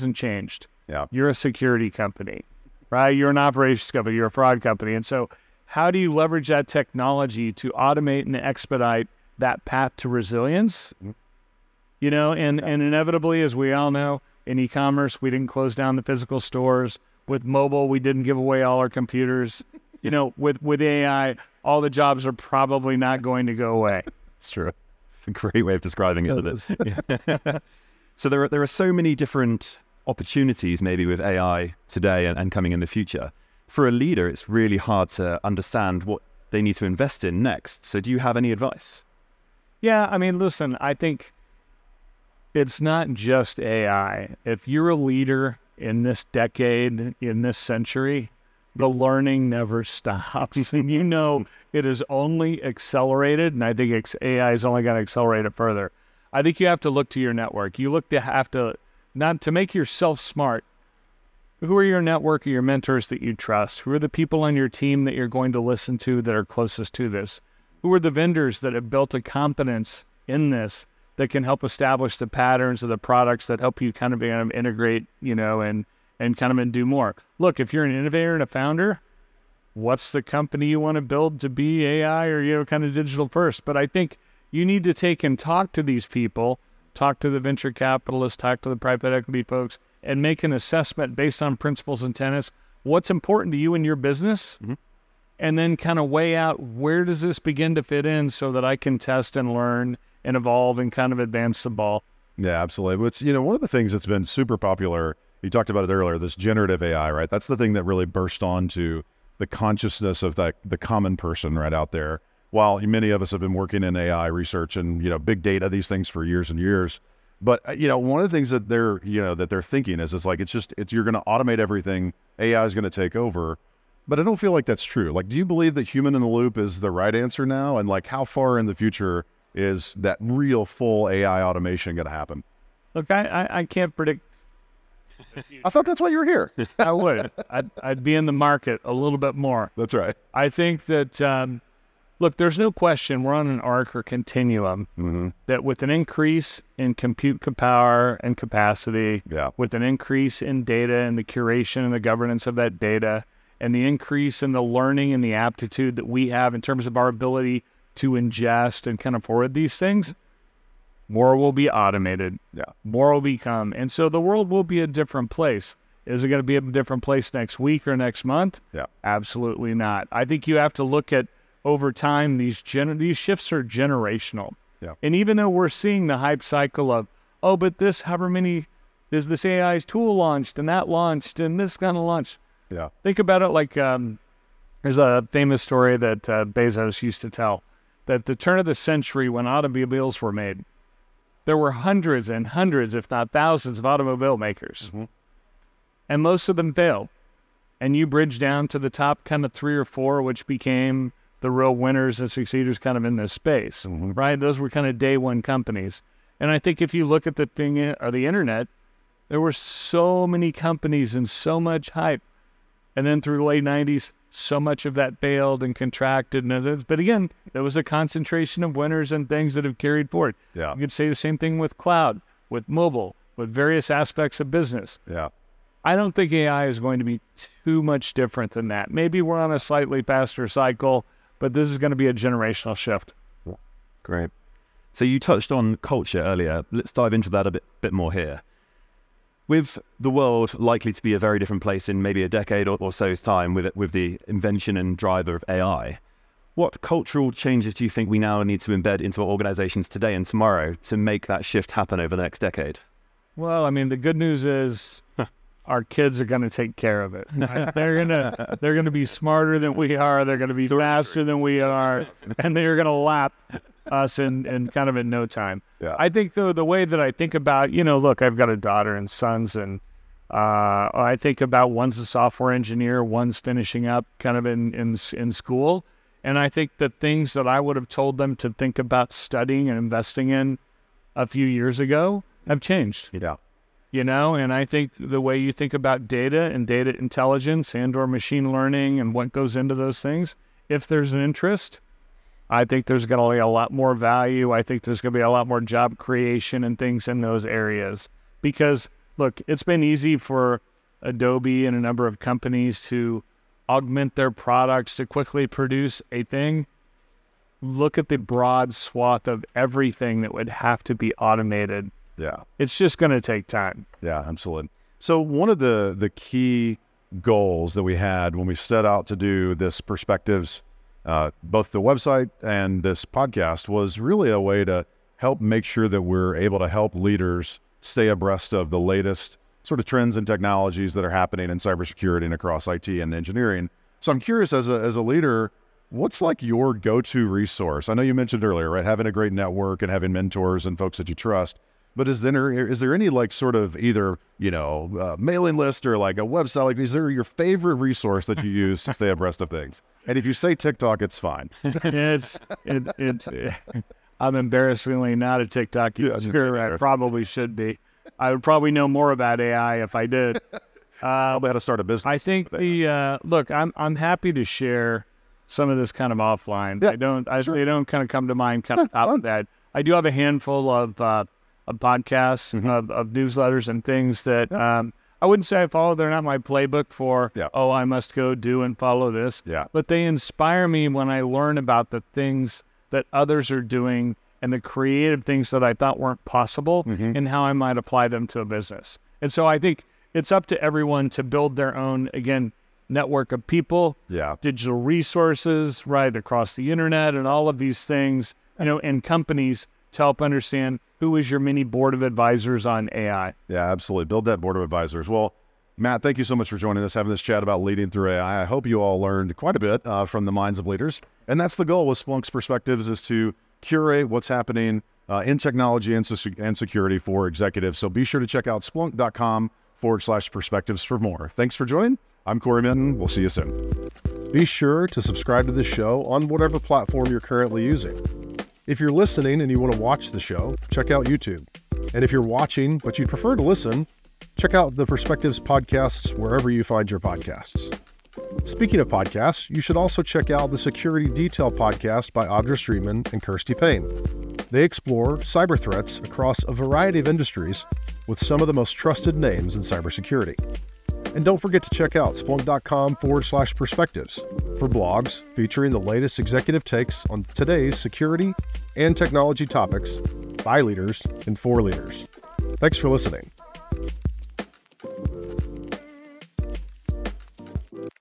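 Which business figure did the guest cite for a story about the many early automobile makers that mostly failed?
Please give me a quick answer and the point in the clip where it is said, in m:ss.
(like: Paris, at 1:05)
Bezos, at 3:06.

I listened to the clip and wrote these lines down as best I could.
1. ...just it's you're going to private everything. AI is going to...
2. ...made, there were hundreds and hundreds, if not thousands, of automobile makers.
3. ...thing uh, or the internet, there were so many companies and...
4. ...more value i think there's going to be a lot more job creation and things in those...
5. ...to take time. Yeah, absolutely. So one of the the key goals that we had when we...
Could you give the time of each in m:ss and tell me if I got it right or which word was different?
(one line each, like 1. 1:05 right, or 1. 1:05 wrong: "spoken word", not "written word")
1. 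2:00 wrong: "automate", not "private"
2. 3:10 right
3. 3:27 right
4. 4:53 right
5. 5:13 right.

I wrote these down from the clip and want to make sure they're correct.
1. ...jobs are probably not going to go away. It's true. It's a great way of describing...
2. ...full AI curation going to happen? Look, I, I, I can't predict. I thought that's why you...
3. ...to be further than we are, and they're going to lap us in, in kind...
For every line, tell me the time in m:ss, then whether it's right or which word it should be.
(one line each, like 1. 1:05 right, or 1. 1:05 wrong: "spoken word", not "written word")
1. 0:21 right
2. 2:10 wrong: "automation", not "curation"
3. 4:20 wrong: "faster", not "further".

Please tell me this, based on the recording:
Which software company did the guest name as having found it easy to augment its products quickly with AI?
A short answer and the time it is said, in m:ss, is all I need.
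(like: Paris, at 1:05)
Adobe, at 5:01.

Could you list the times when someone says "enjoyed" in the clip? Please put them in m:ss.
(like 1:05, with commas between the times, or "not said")
not said.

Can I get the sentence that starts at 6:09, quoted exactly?
I do have a handful of uh, of podcasts, mm -hmm.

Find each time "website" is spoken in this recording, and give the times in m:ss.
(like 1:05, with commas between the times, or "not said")
5:21, 5:46.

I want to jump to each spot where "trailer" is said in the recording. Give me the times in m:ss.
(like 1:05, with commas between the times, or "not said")
not said.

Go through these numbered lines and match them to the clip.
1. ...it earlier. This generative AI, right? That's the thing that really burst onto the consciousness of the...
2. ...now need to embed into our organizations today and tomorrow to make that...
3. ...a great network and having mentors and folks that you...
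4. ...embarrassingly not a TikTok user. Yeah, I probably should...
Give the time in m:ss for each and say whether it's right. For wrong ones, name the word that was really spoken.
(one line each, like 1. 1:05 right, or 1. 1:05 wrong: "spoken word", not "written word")
1. 1:45 right
2. 4:08 right
3. 5:39 right
4. 5:54 right.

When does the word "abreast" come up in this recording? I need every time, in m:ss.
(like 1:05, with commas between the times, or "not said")
5:28, 5:49.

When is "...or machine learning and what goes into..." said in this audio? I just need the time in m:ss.
4:47.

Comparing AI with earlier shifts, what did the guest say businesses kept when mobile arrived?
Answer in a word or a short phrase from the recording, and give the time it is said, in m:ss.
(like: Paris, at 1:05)
computers, at 0:18.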